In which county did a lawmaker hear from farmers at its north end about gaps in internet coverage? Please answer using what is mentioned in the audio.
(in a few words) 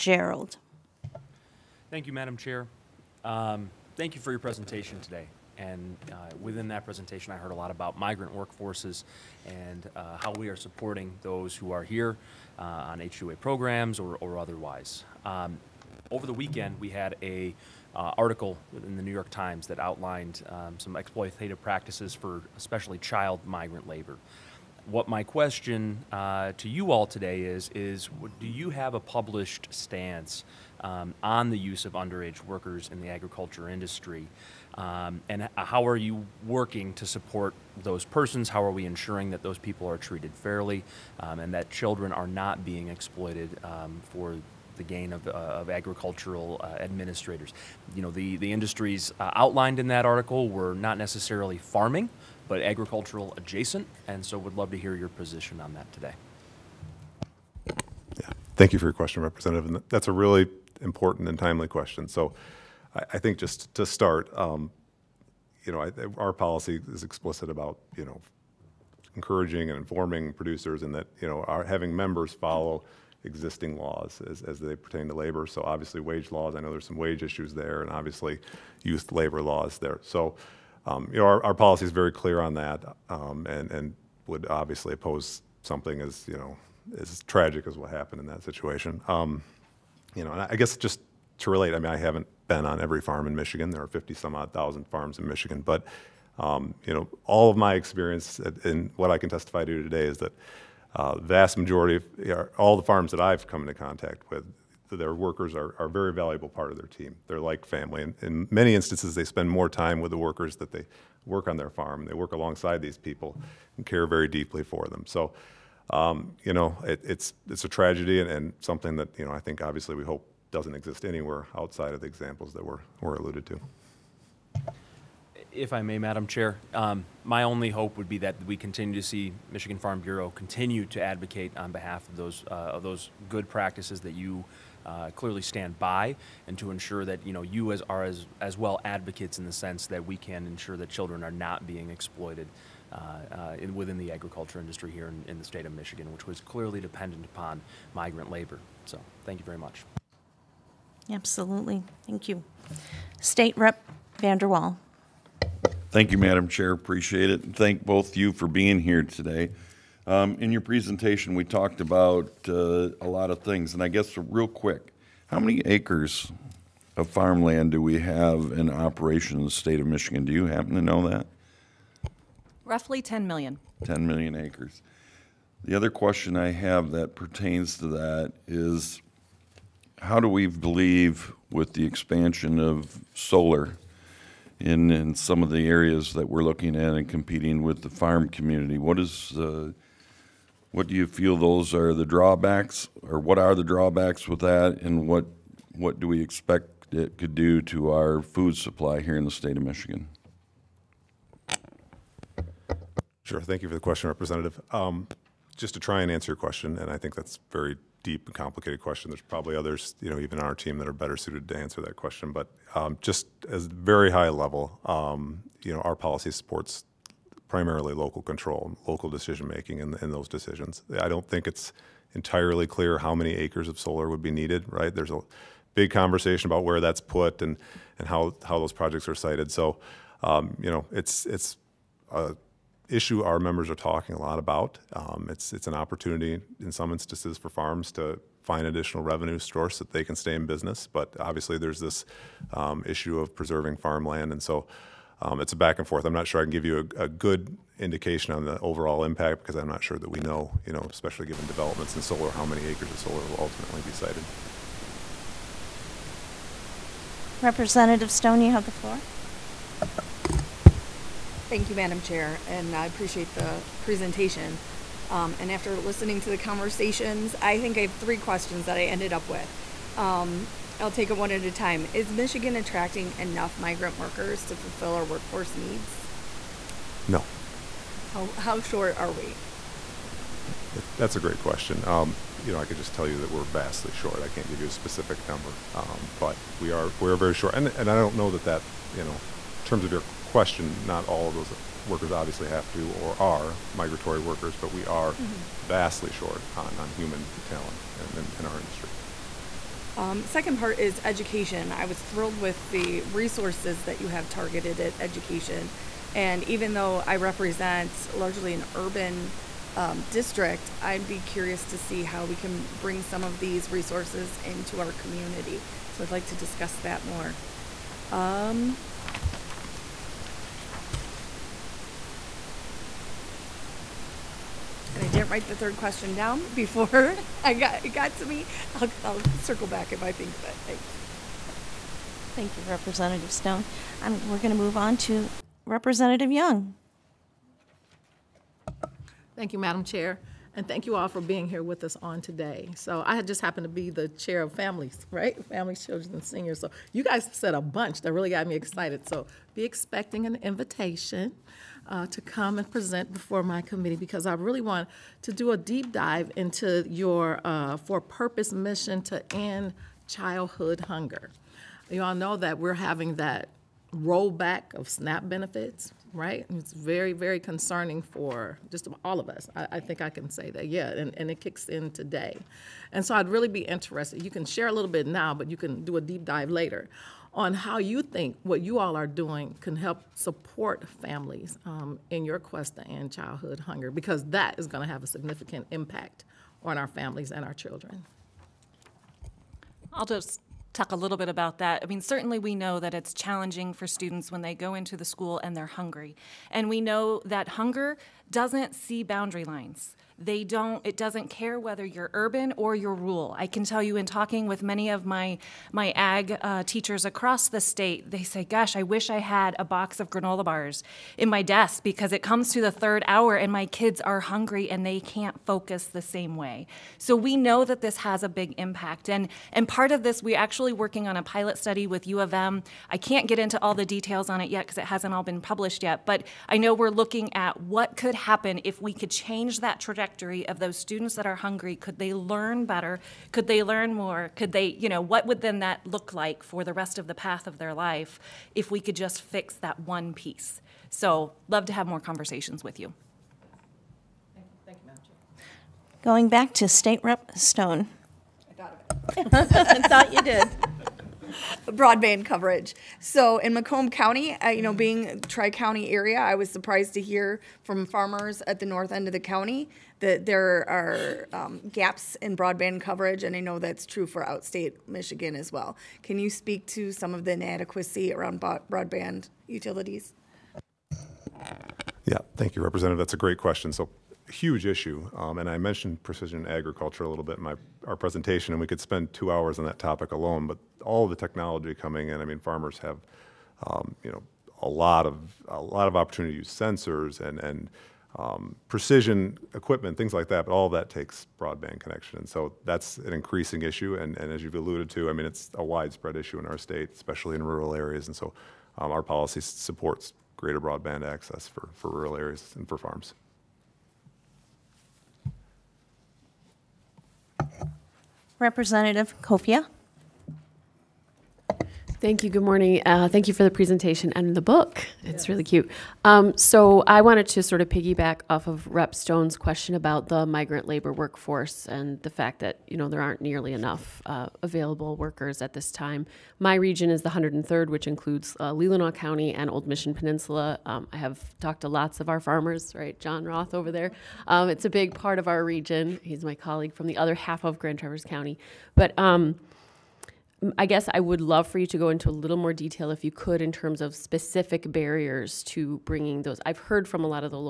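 Macomb County.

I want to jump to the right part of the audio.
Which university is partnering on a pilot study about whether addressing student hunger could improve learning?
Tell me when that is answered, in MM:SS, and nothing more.
07:02.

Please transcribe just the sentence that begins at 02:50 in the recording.
Do you happen to know that?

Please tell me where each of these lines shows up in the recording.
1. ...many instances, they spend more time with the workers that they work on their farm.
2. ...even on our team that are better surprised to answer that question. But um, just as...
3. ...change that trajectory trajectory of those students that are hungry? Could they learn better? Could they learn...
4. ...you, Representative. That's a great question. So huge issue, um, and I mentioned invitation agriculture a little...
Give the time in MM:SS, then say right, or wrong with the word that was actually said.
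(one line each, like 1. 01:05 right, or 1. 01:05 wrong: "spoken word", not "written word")
1. 01:48 right
2. 03:30 wrong: "suited", not "surprised"
3. 07:09 right
4. 07:52 wrong: "precision", not "invitation".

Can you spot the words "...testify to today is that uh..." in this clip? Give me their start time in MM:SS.
01:39.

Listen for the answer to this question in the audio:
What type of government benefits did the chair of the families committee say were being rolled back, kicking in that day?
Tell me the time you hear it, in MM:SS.
06:04.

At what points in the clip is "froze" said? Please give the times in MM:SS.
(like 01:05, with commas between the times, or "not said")
not said.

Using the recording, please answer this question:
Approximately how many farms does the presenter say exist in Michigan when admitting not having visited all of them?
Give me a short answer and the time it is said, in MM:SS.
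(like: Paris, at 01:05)
50 some odd thousand, at 01:33.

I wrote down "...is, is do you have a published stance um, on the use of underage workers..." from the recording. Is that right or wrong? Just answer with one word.
right.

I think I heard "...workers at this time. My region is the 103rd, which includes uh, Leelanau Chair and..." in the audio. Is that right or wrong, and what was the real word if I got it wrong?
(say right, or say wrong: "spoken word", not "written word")
wrong: "County", not "Chair".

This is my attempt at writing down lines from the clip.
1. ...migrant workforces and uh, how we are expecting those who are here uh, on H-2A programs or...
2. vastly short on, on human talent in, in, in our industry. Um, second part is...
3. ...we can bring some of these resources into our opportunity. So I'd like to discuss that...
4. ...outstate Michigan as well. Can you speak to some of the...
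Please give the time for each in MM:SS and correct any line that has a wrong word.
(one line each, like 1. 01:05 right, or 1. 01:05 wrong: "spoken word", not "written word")
1. 00:07 wrong: "supporting", not "expecting"
2. 04:55 right
3. 05:12 wrong: "community", not "opportunity"
4. 07:44 right.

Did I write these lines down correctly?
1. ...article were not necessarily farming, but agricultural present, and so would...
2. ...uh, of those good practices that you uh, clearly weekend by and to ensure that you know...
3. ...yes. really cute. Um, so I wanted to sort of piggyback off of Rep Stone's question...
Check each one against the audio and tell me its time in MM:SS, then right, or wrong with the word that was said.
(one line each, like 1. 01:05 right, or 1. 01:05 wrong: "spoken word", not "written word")
1. 00:50 wrong: "adjacent", not "present"
2. 02:12 wrong: "stand", not "weekend"
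3. 08:35 right.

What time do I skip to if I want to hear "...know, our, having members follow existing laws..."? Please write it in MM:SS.
01:11.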